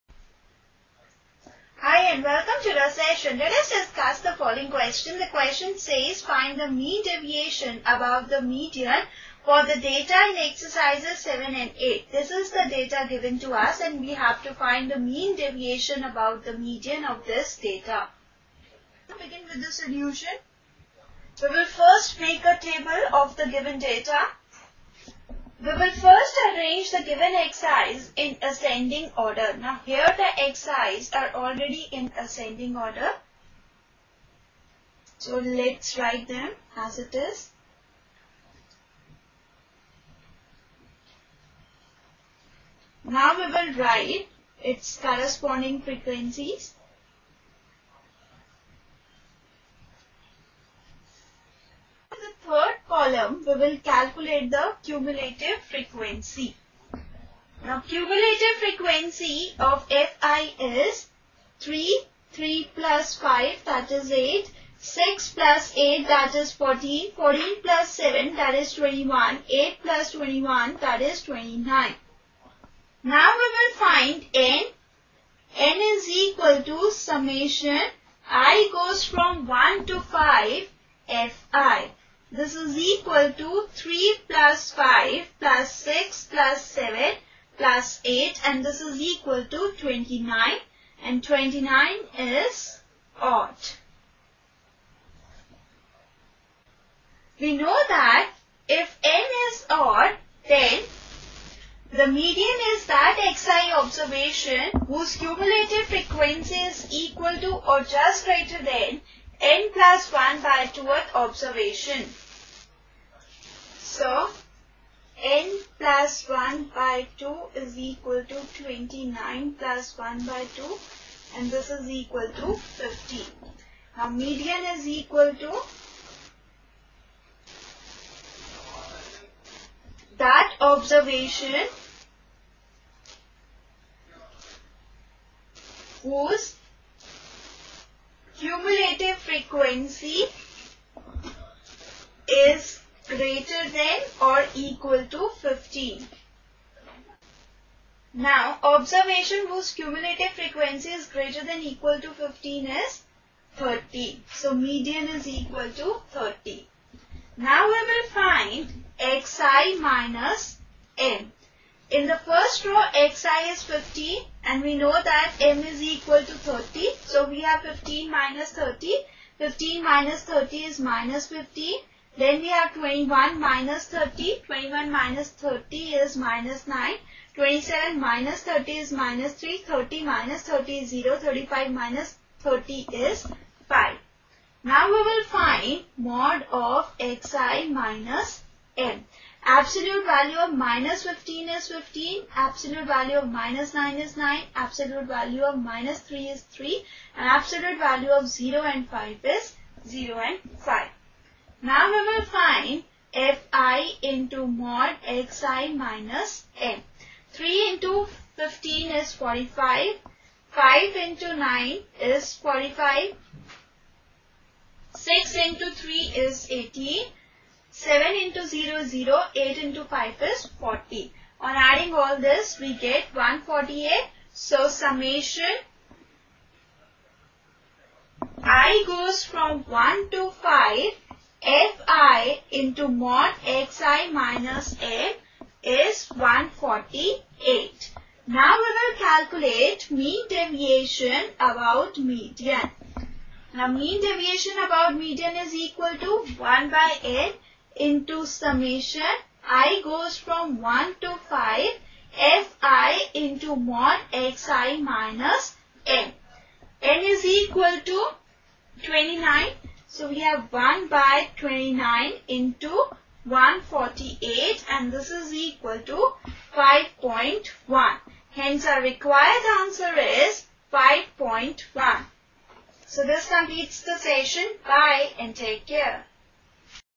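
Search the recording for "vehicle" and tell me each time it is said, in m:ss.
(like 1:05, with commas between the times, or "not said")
not said.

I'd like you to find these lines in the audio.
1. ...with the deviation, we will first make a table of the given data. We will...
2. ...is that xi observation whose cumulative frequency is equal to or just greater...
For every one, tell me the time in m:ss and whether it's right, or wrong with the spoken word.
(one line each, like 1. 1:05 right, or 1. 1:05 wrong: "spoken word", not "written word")
1. 0:19 wrong: "solution", not "deviation"
2. 1:42 right.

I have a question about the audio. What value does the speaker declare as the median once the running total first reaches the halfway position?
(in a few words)
30.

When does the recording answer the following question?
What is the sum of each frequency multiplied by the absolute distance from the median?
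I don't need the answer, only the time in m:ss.
3:42.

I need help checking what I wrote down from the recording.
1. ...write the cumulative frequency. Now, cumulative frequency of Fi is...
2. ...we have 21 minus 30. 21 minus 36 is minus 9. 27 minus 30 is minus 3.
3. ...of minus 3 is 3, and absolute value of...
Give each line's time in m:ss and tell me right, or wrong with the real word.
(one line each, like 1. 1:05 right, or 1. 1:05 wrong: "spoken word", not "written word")
1. 0:53 wrong: "calculate", not "write"
2. 2:52 wrong: "30", not "36"
3. 3:15 right.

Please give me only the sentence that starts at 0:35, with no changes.
So let's write them as it is.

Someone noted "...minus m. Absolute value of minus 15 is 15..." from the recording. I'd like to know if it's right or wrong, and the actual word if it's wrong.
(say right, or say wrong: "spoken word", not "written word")
right.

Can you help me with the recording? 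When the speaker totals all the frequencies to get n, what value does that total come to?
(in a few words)
29.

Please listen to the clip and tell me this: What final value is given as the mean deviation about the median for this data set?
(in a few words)
5.1.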